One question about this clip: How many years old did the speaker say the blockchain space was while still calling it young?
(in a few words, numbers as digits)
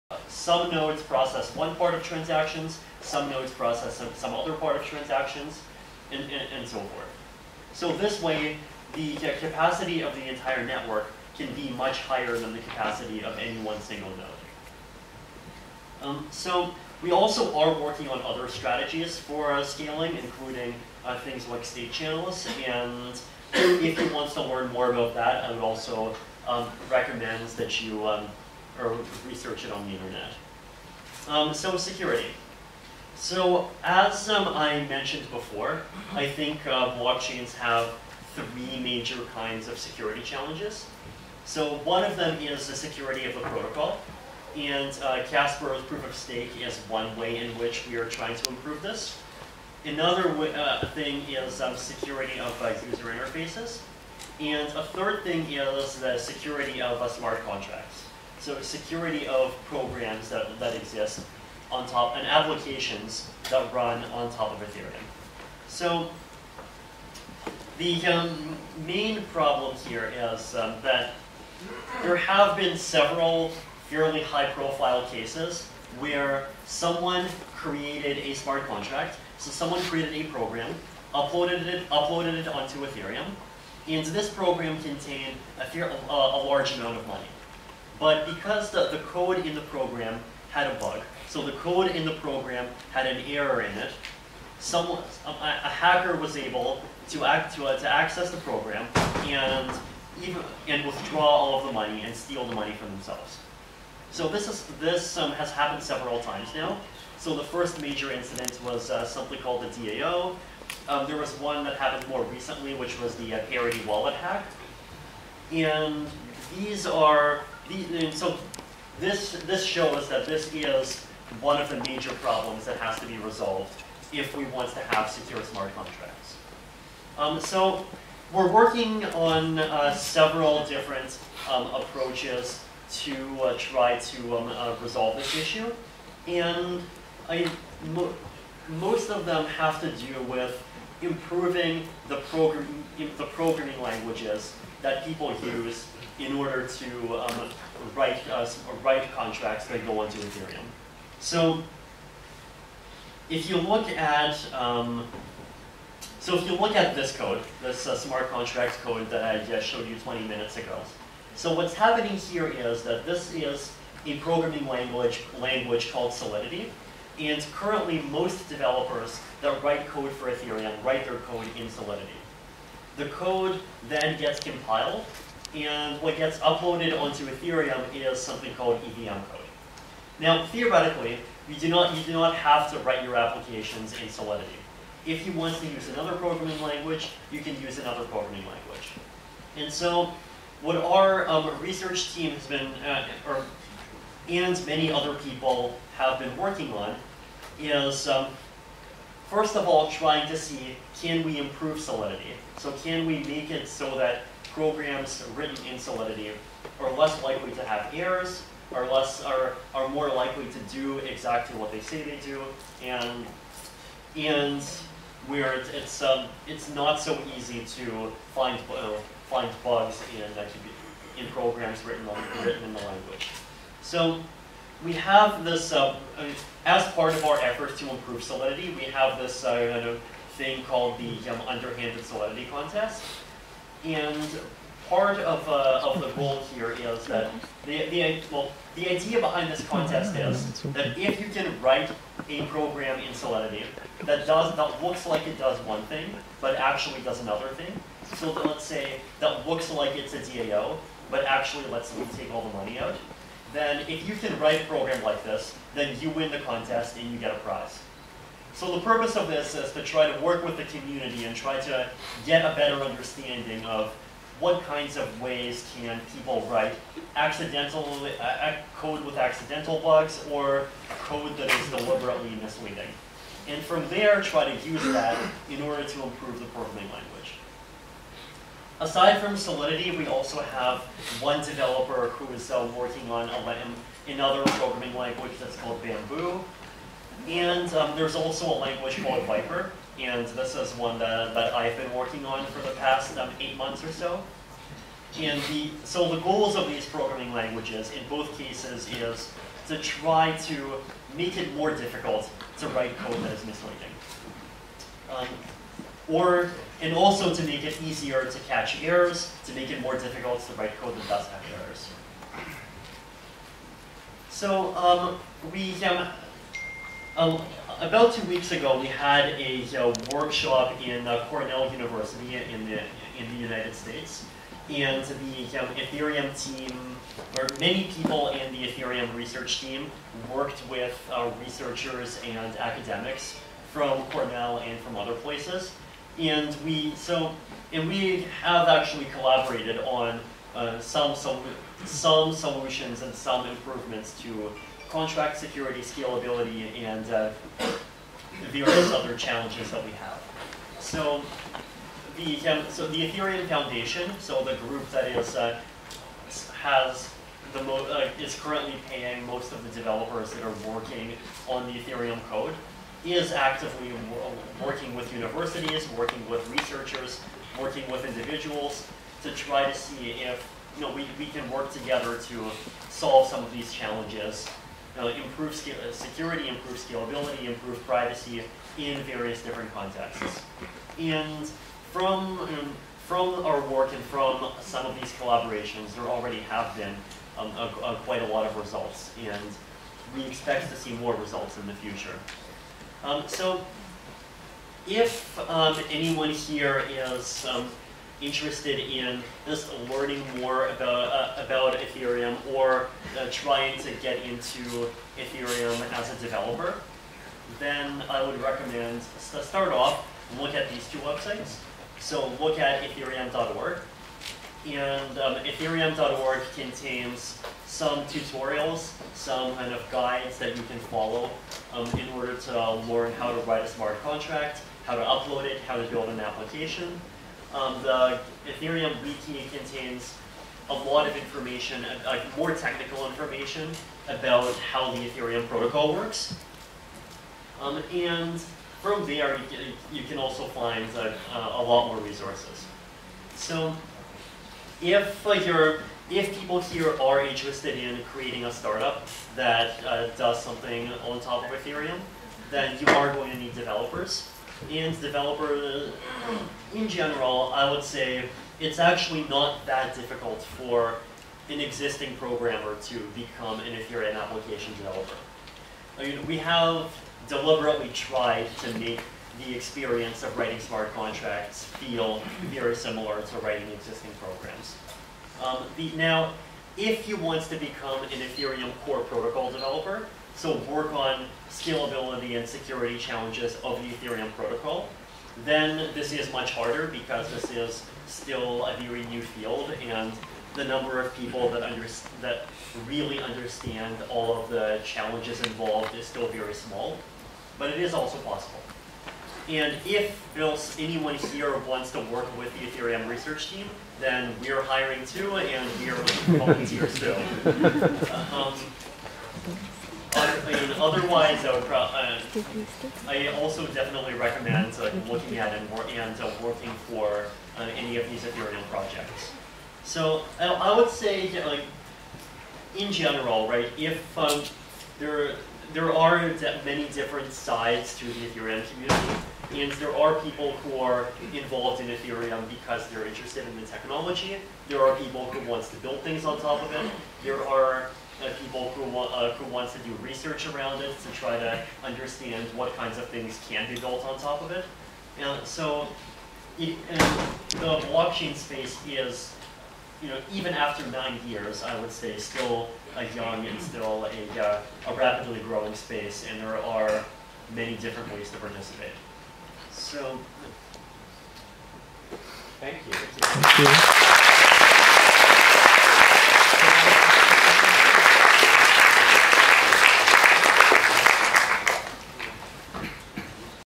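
9.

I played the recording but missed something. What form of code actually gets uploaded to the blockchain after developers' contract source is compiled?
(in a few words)
EVM code.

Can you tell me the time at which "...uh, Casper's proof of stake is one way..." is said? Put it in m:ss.
0:45.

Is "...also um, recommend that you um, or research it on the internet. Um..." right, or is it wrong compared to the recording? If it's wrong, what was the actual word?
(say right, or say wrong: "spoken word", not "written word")
right.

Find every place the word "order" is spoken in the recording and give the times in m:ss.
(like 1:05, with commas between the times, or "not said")
2:26, 4:35, 7:02.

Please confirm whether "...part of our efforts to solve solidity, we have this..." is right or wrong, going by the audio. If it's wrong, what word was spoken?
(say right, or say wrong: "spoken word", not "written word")
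wrong: "improve", not "solve".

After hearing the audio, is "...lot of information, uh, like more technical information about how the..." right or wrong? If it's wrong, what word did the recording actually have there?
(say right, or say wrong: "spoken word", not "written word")
right.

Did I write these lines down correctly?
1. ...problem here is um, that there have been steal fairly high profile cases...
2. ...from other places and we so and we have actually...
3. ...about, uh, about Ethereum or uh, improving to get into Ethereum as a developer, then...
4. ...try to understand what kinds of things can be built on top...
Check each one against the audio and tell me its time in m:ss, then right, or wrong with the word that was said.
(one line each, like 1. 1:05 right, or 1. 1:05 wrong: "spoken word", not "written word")
1. 1:09 wrong: "several", not "steal"
2. 5:34 right
3. 6:40 wrong: "trying", not "improving"
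4. 9:01 right.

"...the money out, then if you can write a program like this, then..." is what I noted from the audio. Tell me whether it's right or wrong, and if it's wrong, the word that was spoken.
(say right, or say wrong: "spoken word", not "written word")
right.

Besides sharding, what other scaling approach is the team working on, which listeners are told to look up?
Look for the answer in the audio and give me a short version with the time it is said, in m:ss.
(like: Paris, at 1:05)
State channels, at 0:21.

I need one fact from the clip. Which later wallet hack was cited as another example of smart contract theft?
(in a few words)
Parity wallet hack.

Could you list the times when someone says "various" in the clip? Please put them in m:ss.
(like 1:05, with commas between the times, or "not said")
5:48, 6:19.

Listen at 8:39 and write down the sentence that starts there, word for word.
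So I would say, like, in general, right?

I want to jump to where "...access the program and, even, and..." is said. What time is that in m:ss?
1:37.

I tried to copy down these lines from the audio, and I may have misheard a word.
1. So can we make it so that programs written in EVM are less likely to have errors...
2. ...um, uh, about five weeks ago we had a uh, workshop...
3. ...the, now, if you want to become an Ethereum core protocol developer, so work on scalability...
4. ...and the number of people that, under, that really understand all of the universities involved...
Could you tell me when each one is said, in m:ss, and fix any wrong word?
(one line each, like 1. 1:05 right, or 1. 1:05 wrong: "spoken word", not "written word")
1. 3:22 wrong: "Solidity", not "EVM"
2. 5:15 wrong: "two", not "five"
3. 7:55 right
4. 8:09 wrong: "challenges", not "universities".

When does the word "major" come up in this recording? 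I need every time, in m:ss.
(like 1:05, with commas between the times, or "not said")
0:38, 1:47, 2:01.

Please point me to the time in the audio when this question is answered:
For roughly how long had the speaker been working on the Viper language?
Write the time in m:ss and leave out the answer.
4:53.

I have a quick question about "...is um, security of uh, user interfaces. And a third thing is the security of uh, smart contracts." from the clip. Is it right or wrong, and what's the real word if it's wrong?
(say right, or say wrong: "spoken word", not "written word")
right.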